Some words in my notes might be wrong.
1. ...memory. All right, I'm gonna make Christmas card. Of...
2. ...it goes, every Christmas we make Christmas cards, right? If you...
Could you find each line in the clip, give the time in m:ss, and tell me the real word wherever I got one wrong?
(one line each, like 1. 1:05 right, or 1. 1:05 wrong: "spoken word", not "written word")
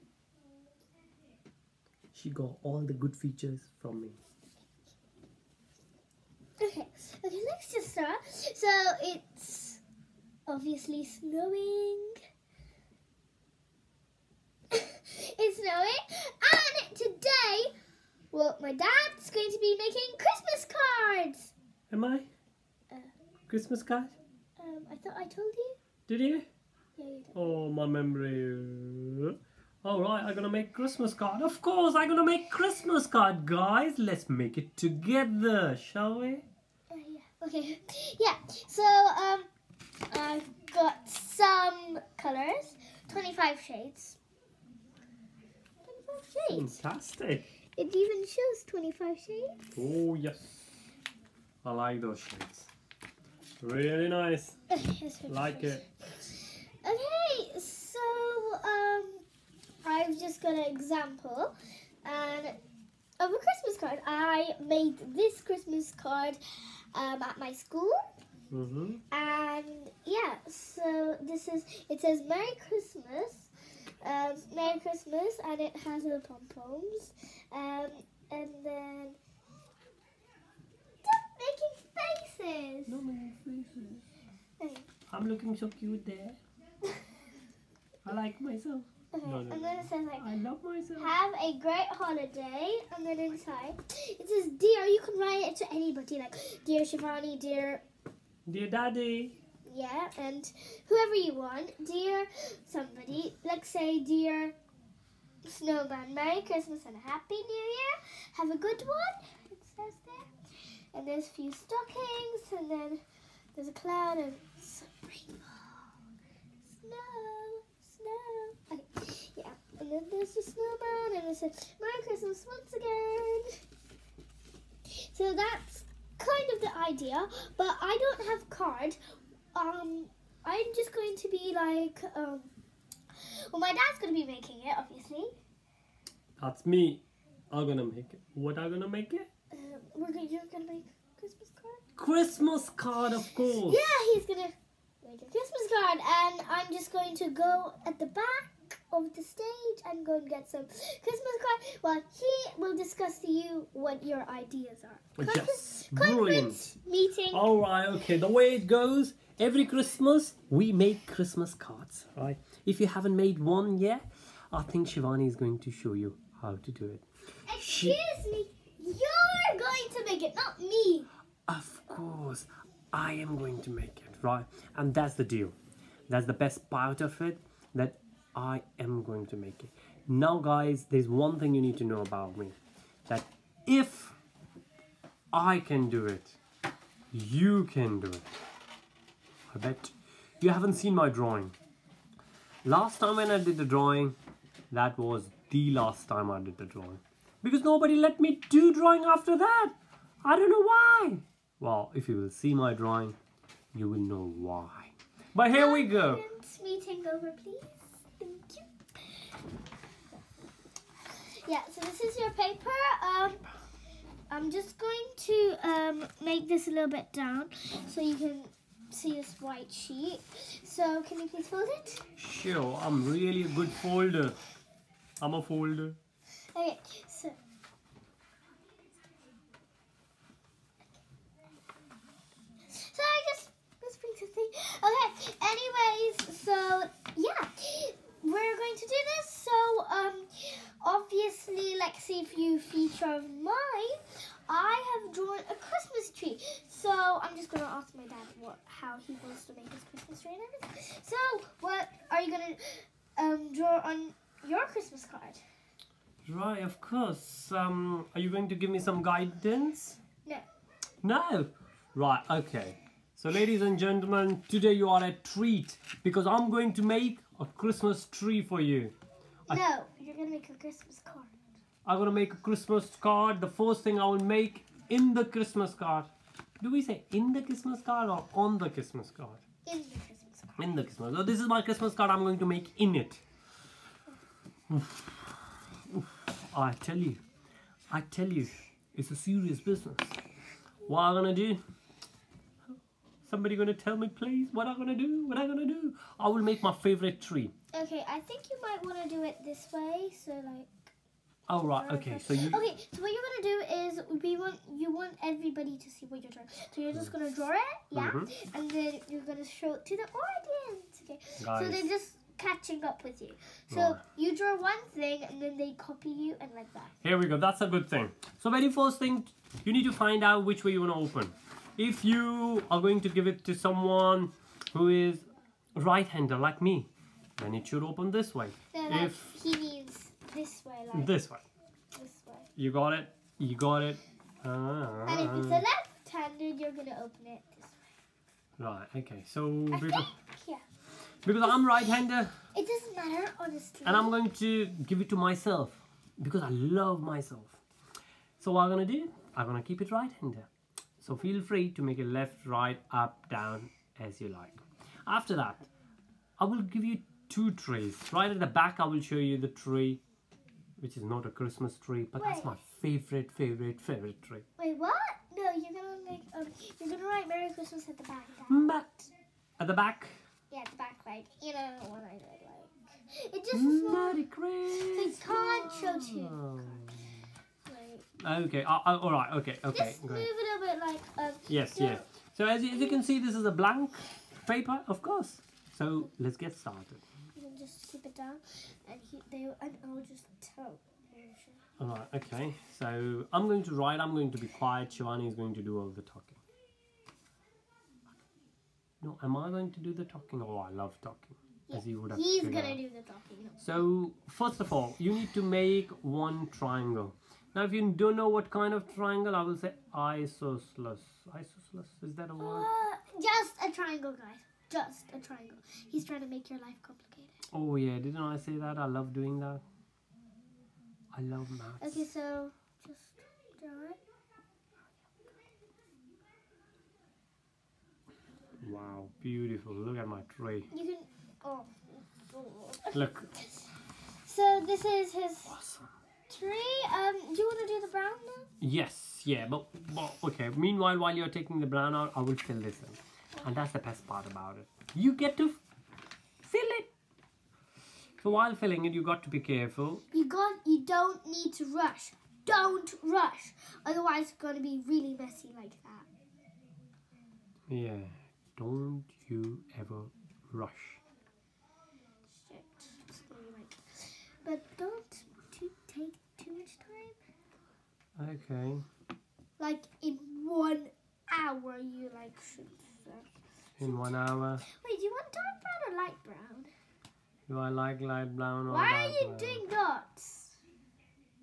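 1. 0:27 right
2. 2:38 right.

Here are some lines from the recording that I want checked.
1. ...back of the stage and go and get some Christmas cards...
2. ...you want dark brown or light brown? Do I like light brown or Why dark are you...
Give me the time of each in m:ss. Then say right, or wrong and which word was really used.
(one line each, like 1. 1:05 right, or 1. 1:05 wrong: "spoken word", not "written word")
1. 2:28 right
2. 7:55 right.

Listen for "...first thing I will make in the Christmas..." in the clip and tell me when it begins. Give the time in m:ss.
4:33.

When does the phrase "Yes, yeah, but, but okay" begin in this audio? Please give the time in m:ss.
7:18.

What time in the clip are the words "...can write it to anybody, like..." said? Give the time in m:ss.
1:35.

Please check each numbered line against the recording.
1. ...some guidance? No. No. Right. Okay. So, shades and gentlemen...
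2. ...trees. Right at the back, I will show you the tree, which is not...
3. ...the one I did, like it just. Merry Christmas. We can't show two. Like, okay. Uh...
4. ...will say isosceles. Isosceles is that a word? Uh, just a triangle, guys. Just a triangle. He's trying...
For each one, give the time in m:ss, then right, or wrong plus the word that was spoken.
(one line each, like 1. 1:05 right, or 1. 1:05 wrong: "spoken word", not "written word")
1. 4:18 wrong: "ladies", not "shades"
2. 5:57 right
3. 6:11 right
4. 6:49 right.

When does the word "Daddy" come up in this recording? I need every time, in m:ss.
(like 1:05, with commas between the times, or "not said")
1:38.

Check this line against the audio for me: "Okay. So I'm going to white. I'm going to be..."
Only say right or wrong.
wrong.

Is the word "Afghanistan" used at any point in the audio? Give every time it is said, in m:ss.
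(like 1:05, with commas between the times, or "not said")
not said.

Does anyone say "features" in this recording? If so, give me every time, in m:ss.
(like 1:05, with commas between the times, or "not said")
0:03, 4:02.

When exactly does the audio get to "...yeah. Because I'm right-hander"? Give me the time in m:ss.
5:40.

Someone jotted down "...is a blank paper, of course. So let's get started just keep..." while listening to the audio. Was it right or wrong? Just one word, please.
right.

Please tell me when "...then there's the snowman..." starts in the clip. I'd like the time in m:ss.
1:59.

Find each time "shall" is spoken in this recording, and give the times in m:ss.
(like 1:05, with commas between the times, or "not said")
0:35.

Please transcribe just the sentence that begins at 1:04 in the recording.
I made this Christmas card um, at my school.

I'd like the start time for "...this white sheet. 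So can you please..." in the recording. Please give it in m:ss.
3:39.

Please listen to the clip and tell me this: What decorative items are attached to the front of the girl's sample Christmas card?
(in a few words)
pom poms.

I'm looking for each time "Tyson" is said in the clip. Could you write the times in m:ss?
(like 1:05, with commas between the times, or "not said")
not said.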